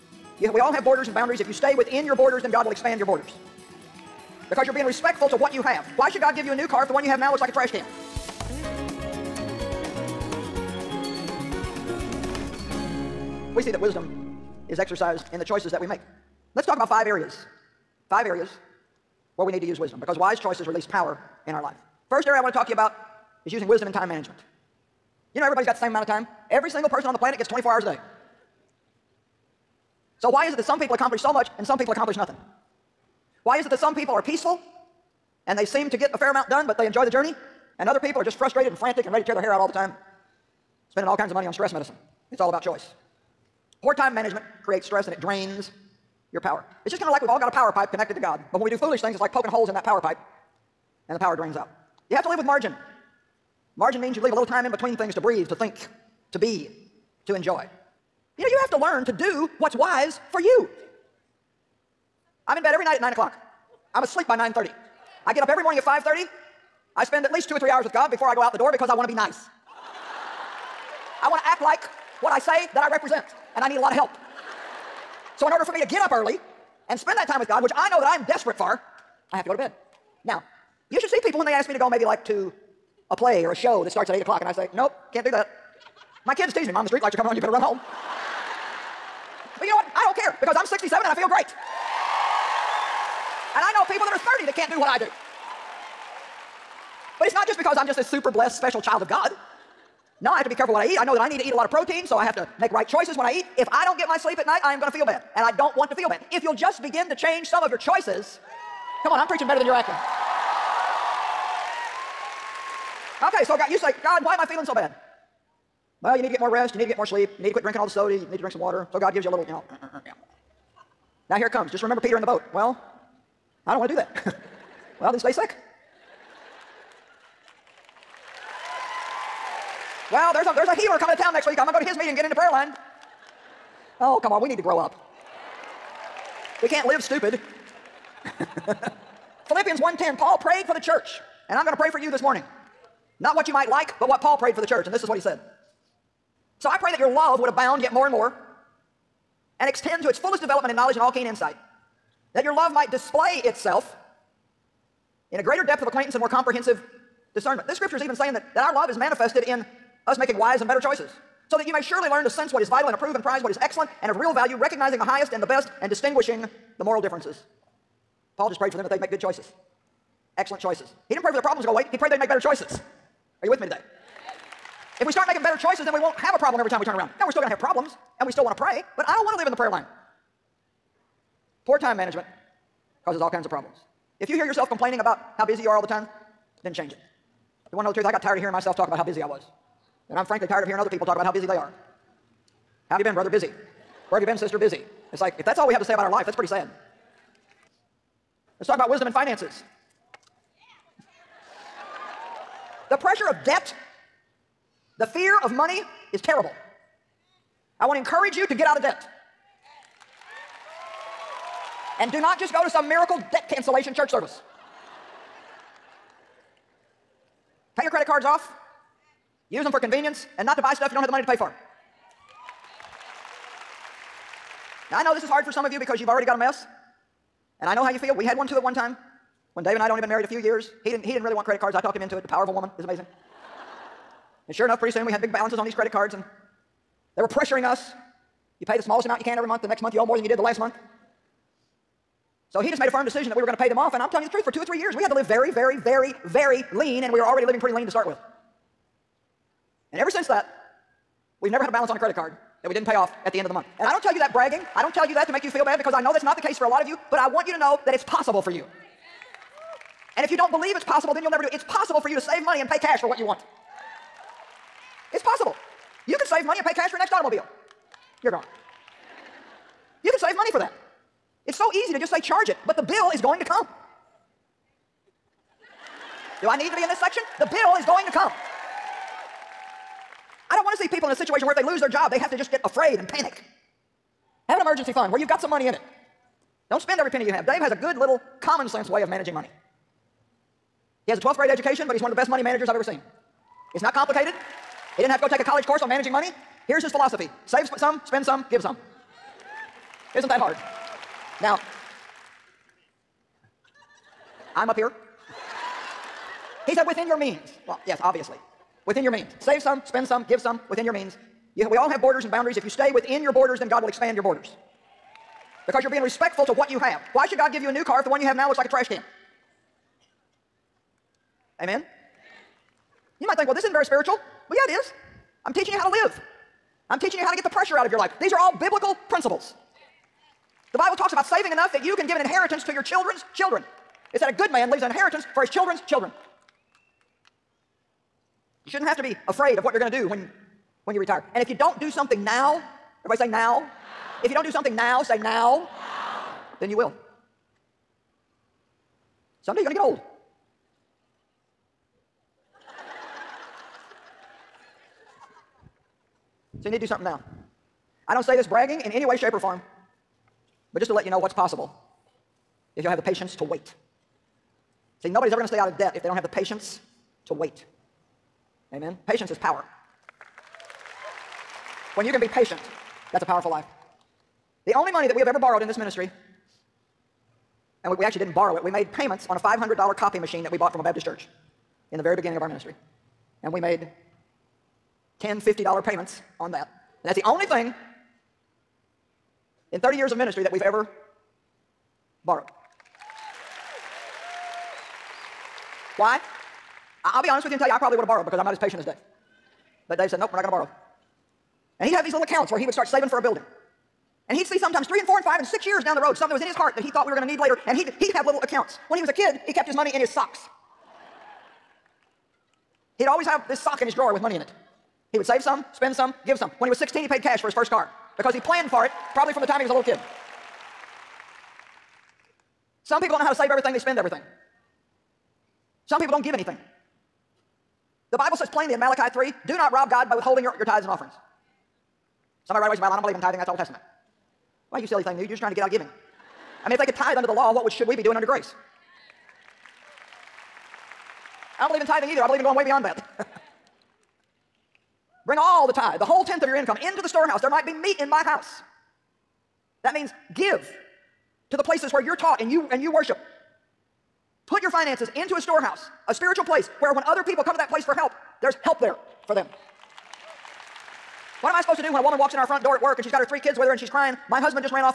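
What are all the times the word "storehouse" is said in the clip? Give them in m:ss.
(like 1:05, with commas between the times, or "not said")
7:27, 7:35.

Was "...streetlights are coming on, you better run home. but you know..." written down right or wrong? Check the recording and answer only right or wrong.
right.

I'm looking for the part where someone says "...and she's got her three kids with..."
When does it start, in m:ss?
7:42.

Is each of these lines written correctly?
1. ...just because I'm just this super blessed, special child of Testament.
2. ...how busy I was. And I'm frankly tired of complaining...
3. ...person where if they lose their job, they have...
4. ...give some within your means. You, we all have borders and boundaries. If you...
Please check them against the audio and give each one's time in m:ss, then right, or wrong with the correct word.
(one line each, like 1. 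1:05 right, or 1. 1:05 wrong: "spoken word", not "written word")
1. 1:37 wrong: "God", not "Testament"
2. 3:08 wrong: "hearing", not "complaining"
3. 4:41 wrong: "situation", not "person"
4. 5:10 right.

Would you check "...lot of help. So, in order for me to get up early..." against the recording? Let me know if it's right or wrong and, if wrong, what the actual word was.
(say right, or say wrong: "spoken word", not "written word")
right.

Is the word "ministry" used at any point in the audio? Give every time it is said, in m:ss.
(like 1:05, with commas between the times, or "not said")
6:15, 6:22, 6:30.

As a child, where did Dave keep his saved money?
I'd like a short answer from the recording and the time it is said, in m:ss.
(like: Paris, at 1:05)
in his socks, at 6:49.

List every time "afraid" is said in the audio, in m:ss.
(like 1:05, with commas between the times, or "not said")
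4:42, 5:39.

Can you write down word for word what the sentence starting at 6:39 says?
But Dave said, nope, we're not going to borrow.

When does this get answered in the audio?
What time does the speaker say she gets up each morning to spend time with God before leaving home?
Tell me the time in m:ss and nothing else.
1:05.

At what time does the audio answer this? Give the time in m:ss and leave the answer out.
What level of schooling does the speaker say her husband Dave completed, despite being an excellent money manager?
4:51.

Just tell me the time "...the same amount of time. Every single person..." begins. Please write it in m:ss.
0:25.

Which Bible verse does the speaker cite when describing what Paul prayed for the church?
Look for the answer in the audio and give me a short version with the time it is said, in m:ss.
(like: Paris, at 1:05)
Philippians 1:10, at 2:19.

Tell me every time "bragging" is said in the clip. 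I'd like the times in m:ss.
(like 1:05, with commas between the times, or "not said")
4:14, 5:58.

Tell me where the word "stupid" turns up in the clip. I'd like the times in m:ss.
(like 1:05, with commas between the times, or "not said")
2:17.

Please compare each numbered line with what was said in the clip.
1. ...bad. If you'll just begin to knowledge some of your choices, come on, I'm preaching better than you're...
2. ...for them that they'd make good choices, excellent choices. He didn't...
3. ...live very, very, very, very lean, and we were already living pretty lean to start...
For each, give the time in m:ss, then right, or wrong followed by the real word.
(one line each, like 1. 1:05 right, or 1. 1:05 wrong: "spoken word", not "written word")
1. 1:46 wrong: "change", not "knowledge"
2. 2:48 right
3. 4:05 right.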